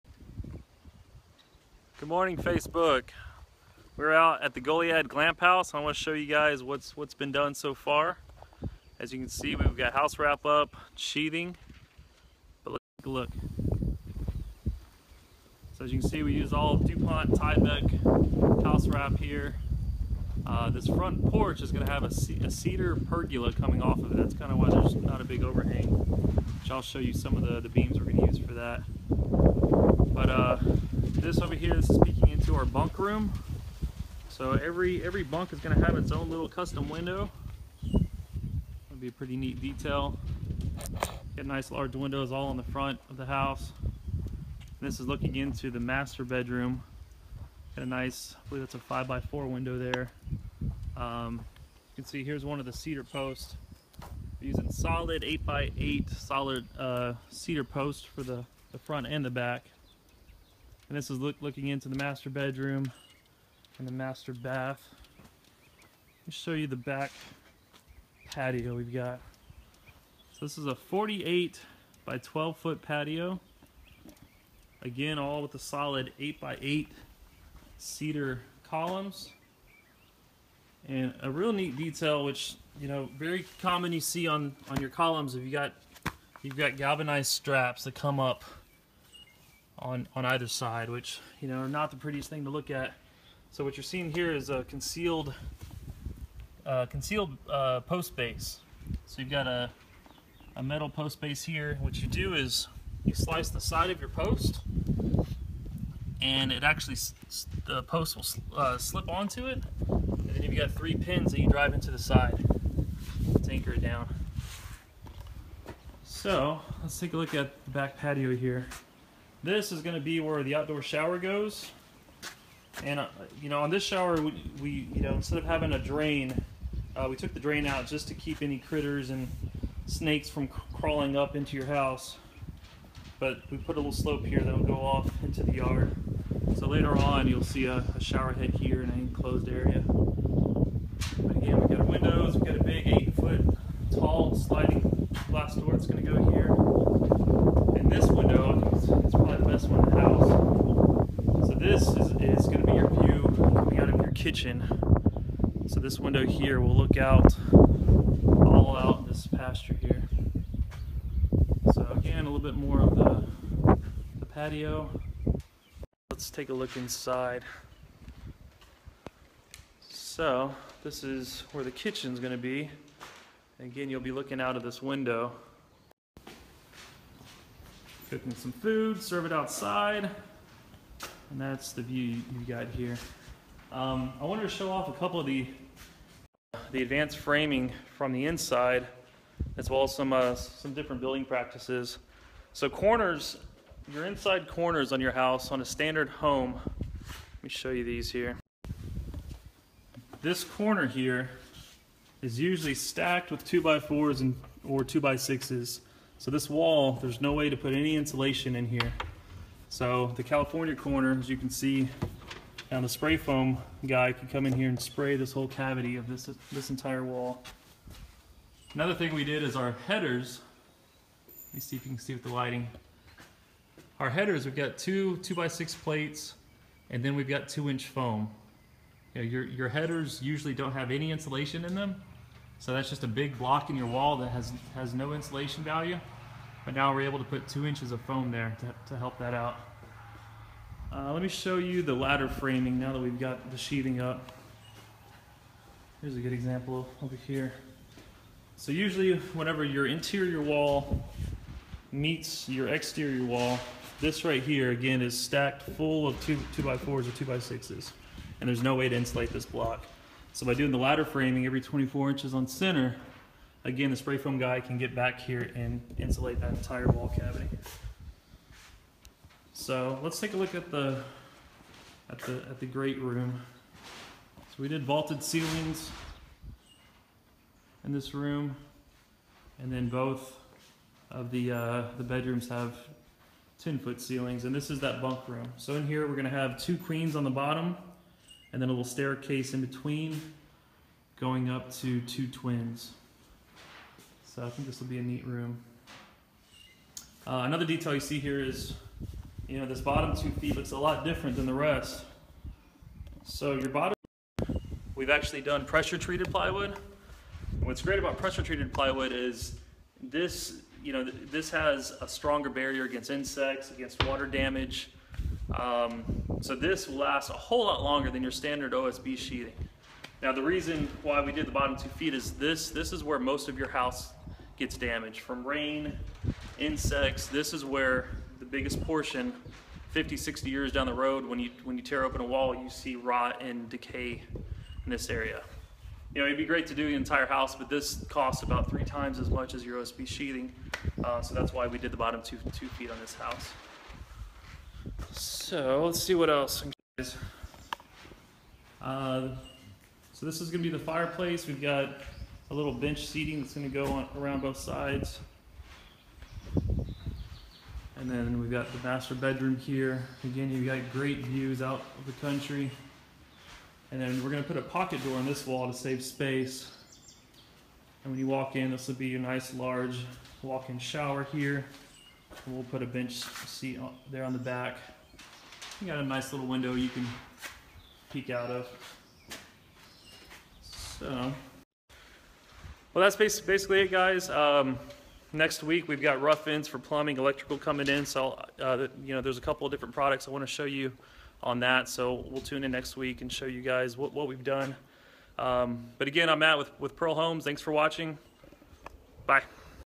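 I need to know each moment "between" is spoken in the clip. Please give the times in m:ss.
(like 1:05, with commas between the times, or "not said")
4:49.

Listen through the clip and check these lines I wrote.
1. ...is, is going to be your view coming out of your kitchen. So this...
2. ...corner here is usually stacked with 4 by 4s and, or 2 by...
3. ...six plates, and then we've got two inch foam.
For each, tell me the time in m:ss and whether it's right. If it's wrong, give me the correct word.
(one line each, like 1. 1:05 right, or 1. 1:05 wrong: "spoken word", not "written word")
1. 2:31 right
2. 3:20 wrong: "2", not "4"
3. 3:45 right.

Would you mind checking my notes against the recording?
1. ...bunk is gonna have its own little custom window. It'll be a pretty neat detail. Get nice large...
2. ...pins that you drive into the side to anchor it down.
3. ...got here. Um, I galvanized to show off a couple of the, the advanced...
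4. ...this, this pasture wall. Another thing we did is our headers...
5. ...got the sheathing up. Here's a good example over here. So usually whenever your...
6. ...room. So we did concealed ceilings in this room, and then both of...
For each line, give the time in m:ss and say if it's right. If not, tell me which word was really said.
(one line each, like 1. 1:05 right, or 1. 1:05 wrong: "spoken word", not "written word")
1. 0:35 right
2. 1:50 right
3. 3:02 wrong: "wanted", not "galvanized"
4. 3:36 wrong: "entire", not "pasture"
5. 4:03 right
6. 4:32 wrong: "vaulted", not "concealed".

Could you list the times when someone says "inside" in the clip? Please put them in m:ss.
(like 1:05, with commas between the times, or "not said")
2:46, 3:08, 3:14.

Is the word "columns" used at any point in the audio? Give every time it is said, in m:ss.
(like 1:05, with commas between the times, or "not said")
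1:18, 1:24.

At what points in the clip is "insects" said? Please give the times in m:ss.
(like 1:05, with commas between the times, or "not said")
5:13, 5:26.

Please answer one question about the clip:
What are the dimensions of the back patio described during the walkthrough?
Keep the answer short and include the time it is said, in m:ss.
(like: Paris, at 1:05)
48 by 12 feet, at 1:10.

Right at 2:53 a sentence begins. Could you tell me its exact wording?
Again, you'll be looking out of this window cooking some food, serve it outside.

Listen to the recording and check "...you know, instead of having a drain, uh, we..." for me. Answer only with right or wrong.
right.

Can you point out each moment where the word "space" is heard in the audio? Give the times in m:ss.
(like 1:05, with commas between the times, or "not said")
6:06.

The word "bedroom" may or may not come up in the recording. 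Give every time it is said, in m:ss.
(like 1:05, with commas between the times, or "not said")
0:46, 1:02, 4:42, 5:59.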